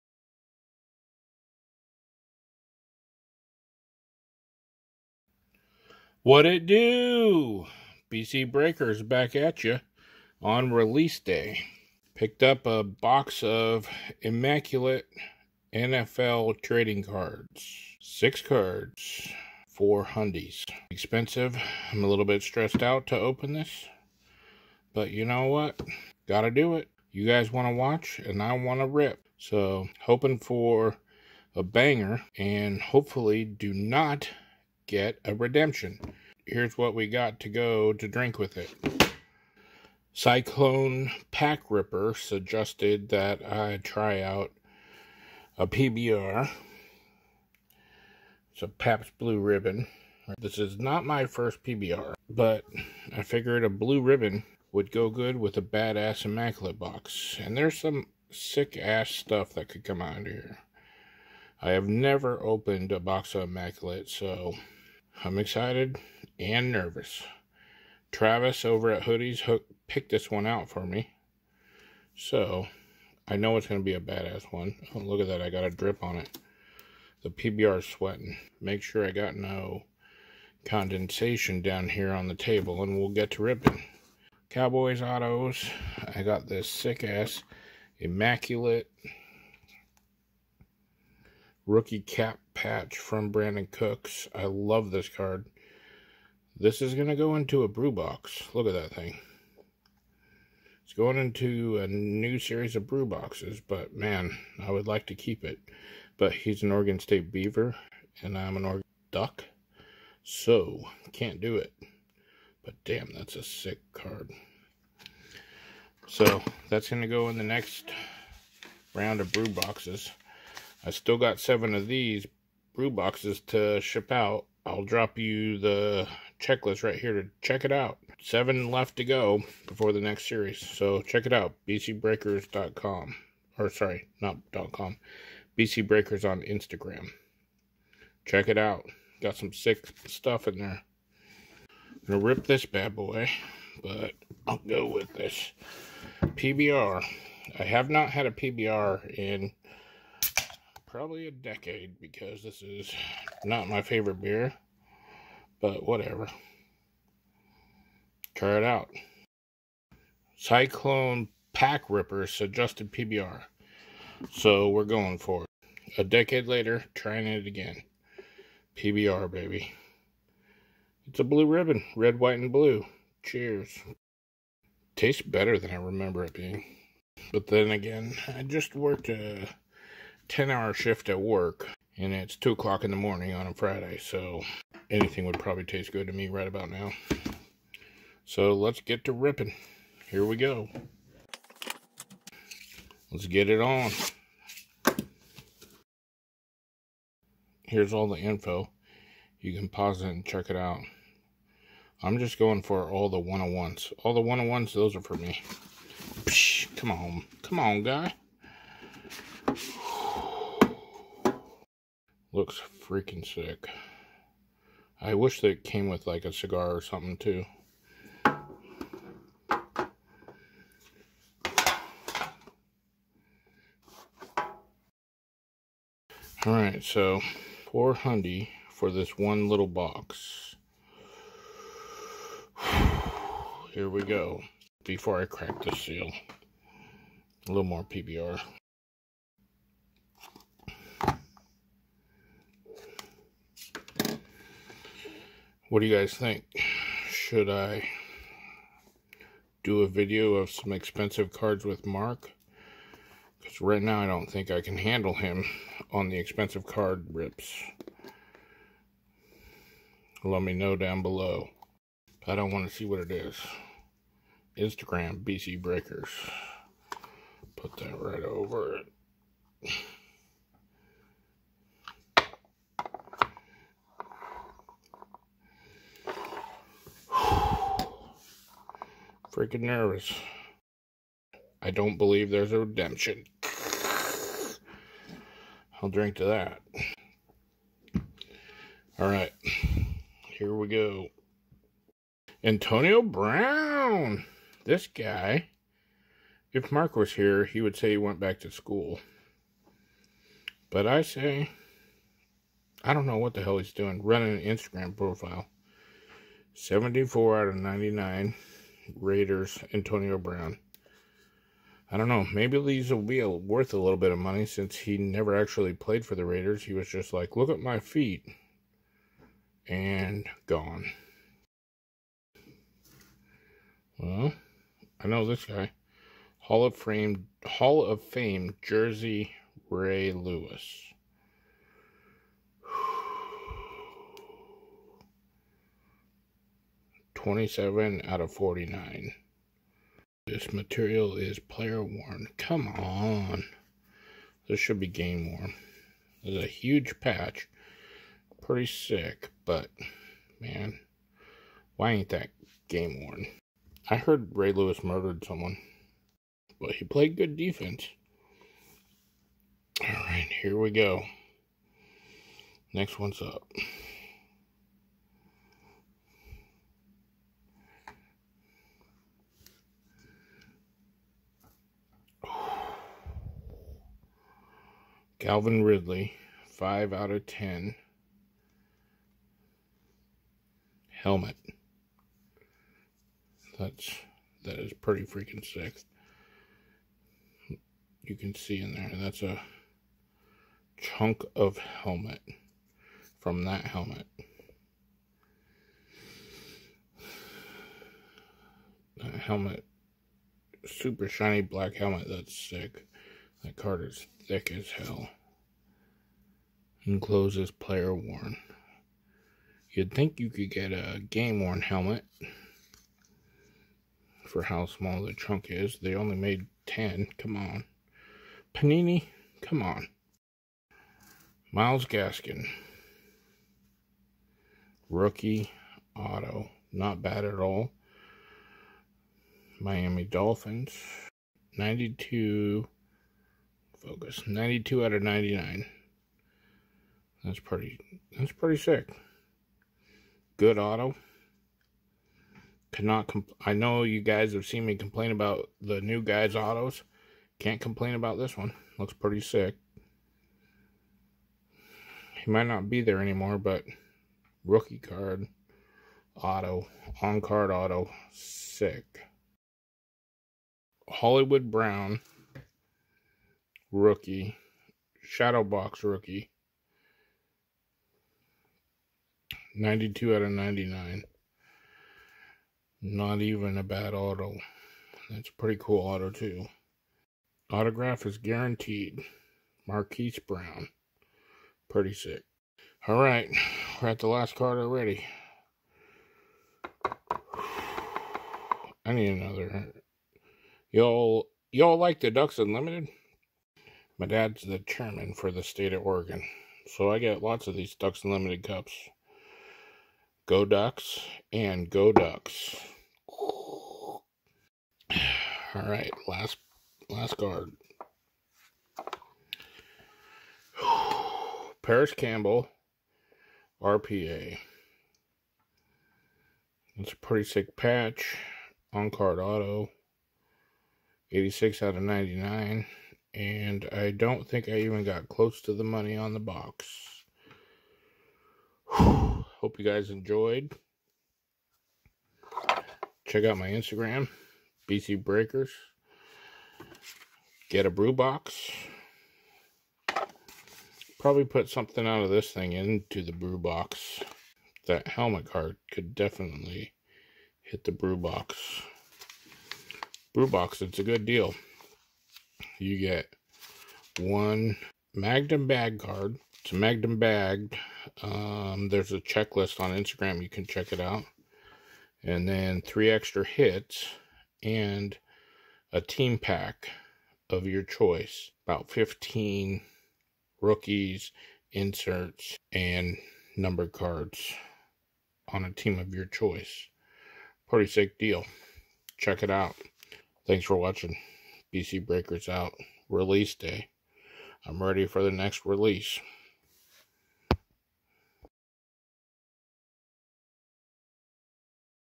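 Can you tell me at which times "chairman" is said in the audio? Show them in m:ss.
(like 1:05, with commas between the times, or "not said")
8:14.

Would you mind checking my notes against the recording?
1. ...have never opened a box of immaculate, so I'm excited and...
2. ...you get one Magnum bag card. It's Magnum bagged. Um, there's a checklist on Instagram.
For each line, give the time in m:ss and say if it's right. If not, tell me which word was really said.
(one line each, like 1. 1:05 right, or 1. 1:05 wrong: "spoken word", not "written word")
1. 1:01 right
2. 9:12 right.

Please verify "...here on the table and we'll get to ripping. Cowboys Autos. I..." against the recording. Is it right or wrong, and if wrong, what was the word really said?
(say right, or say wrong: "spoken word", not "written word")
right.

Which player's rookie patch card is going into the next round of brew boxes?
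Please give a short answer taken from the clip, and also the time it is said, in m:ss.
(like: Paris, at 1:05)
Brandin Cooks, at 1:33.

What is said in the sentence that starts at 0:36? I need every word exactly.
Here's what we got to go to drink with it.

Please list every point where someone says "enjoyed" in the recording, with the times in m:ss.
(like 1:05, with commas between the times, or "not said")
8:49.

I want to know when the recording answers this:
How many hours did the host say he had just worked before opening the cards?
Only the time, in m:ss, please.
3:00.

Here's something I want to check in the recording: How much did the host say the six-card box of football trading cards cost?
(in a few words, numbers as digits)
$400.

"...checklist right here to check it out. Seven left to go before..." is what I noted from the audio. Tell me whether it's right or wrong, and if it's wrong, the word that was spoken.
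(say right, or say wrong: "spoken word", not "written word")
right.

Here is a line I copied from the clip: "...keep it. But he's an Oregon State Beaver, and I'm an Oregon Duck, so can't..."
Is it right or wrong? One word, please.
right.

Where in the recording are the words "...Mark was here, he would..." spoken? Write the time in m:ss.
4:56.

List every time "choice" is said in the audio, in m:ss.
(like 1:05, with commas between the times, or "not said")
9:27, 9:36.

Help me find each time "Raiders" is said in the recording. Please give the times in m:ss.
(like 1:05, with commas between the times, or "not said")
5:08, 5:16.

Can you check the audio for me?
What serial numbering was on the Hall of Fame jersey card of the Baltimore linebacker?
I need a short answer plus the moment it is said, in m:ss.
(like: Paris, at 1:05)
27/49, at 5:37.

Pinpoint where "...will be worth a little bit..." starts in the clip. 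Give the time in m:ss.
5:12.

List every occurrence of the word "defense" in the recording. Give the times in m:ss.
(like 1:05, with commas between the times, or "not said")
5:57.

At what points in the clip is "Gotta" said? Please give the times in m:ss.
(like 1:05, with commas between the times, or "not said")
0:26.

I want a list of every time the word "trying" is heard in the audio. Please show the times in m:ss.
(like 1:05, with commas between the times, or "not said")
2:46.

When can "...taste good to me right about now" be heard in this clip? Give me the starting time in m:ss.
3:05.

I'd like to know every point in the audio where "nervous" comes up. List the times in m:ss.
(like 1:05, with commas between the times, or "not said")
1:06, 4:39.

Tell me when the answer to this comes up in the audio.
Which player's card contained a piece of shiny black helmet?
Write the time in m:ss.
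6:15.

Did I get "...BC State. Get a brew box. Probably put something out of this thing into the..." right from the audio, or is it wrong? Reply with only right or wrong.
wrong.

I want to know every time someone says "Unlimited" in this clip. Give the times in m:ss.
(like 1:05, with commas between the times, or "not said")
8:12, 8:18.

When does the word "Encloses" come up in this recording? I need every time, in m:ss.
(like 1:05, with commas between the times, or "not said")
6:46.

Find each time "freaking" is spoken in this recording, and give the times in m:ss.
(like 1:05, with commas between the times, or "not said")
3:32, 4:39, 6:25.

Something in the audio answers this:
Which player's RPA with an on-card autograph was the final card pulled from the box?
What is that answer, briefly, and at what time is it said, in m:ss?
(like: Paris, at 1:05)
Parris Campbell, at 8:31.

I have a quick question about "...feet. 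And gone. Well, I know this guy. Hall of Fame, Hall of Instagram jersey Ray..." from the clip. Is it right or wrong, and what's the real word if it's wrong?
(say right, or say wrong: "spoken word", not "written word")
wrong: "Fame", not "Instagram".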